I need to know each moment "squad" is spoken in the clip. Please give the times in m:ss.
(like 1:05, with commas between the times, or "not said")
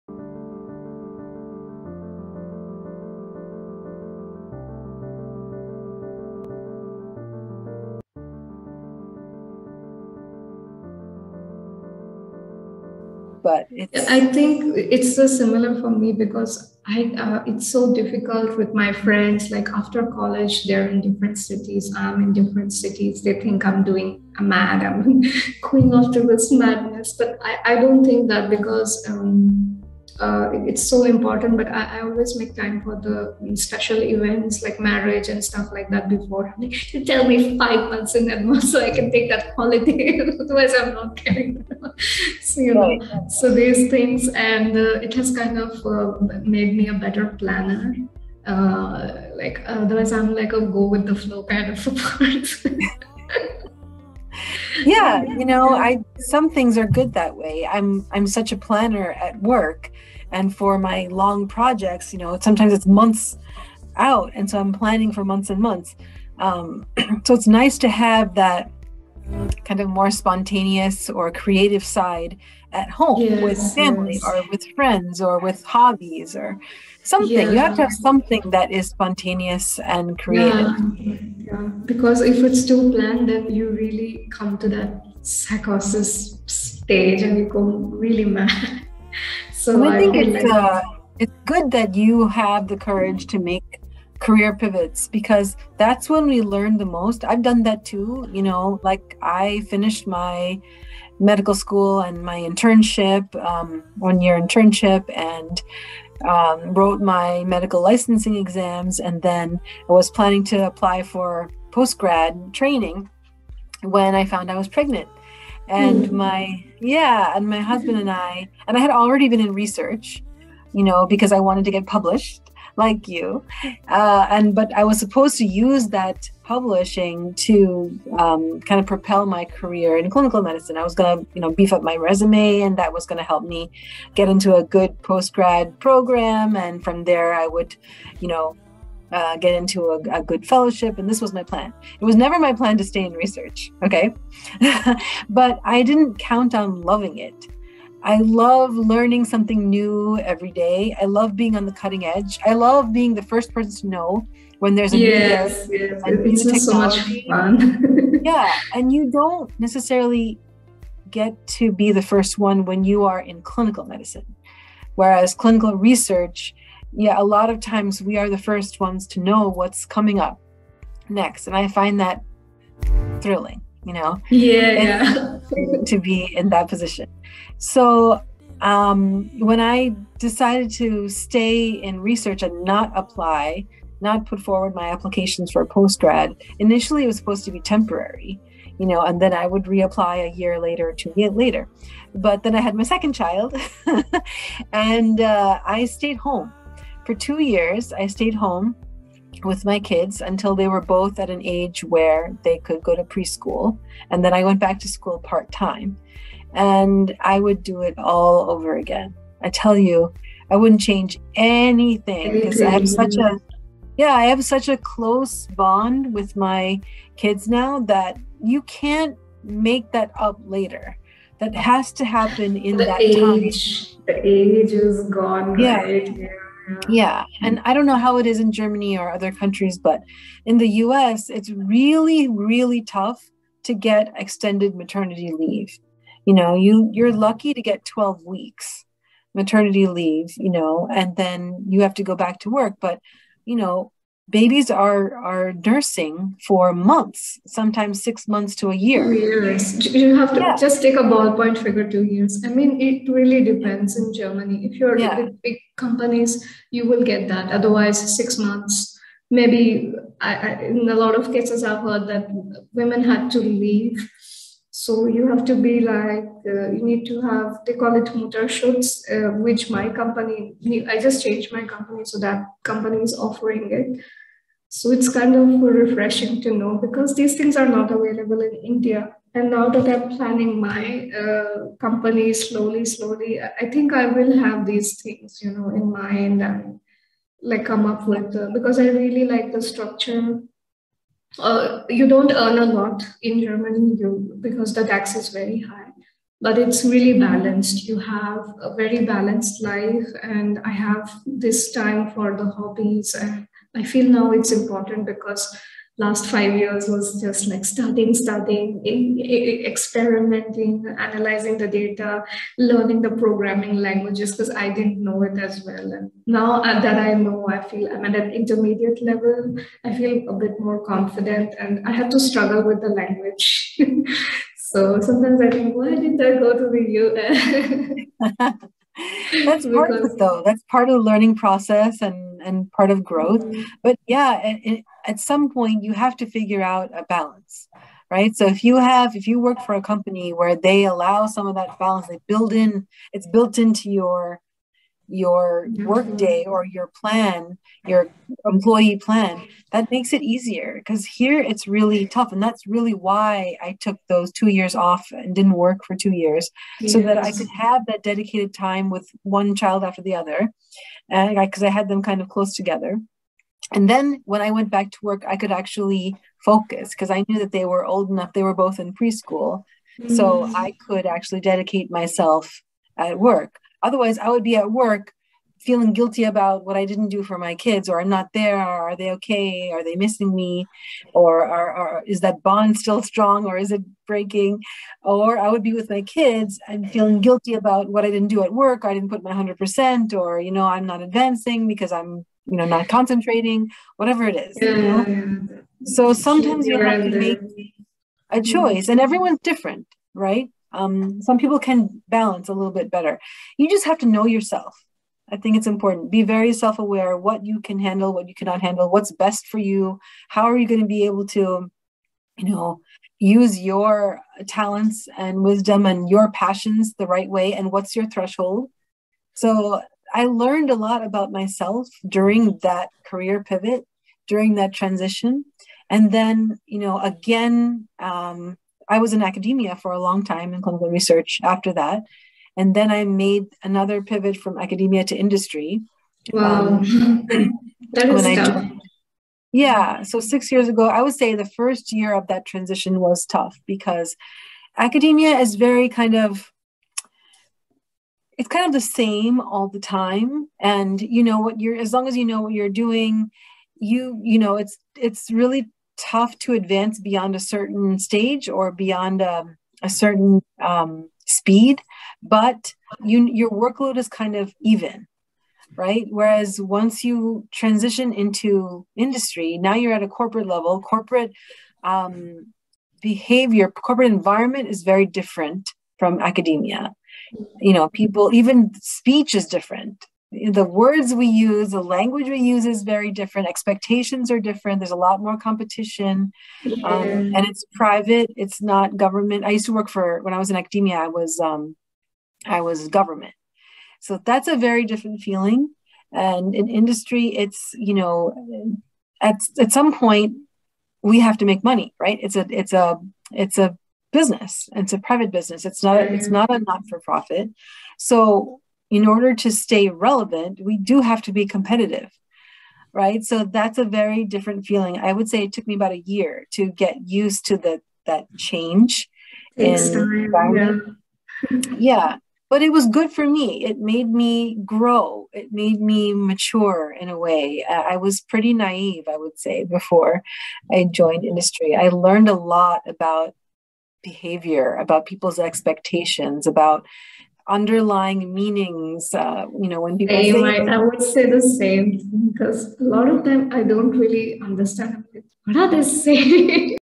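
not said.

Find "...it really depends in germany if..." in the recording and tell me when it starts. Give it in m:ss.
4:12.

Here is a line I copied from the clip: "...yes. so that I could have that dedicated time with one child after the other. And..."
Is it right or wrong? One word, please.
right.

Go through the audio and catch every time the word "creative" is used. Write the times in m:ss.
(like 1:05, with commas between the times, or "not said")
1:11, 1:20.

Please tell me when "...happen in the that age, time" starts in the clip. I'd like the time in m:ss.
3:42.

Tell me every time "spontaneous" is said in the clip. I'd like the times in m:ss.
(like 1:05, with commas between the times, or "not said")
1:10, 1:18.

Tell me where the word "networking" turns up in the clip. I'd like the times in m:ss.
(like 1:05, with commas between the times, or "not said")
not said.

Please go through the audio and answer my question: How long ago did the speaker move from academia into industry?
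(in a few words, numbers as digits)
6 years ago.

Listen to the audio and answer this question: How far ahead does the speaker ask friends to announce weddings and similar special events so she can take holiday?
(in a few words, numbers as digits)
5 months.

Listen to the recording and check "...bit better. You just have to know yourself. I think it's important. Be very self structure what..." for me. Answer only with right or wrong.
wrong.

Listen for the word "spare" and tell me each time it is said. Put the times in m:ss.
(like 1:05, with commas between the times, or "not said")
not said.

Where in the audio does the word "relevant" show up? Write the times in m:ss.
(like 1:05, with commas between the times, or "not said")
8:29.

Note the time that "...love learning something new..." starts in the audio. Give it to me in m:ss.
2:28.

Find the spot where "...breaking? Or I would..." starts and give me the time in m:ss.
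6:24.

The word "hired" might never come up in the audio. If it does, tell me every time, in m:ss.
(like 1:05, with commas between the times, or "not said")
not said.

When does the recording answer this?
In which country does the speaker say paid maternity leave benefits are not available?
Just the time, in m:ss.
4:38.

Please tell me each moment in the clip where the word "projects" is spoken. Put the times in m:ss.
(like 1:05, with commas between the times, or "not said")
1:01.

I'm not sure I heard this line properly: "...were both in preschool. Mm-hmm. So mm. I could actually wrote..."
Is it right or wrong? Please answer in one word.
wrong.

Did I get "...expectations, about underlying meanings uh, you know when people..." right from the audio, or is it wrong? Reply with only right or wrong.
right.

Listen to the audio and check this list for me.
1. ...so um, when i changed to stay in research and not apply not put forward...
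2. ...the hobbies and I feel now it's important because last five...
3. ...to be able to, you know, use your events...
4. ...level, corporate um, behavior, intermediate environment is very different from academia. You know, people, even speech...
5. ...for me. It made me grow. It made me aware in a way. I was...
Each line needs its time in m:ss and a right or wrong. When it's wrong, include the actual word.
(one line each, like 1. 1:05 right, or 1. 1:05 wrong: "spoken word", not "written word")
1. 2:57 wrong: "decided", not "changed"
2. 5:02 right
3. 6:50 wrong: "talents", not "events"
4. 7:50 wrong: "corporate", not "intermediate"
5. 8:43 wrong: "mature", not "aware".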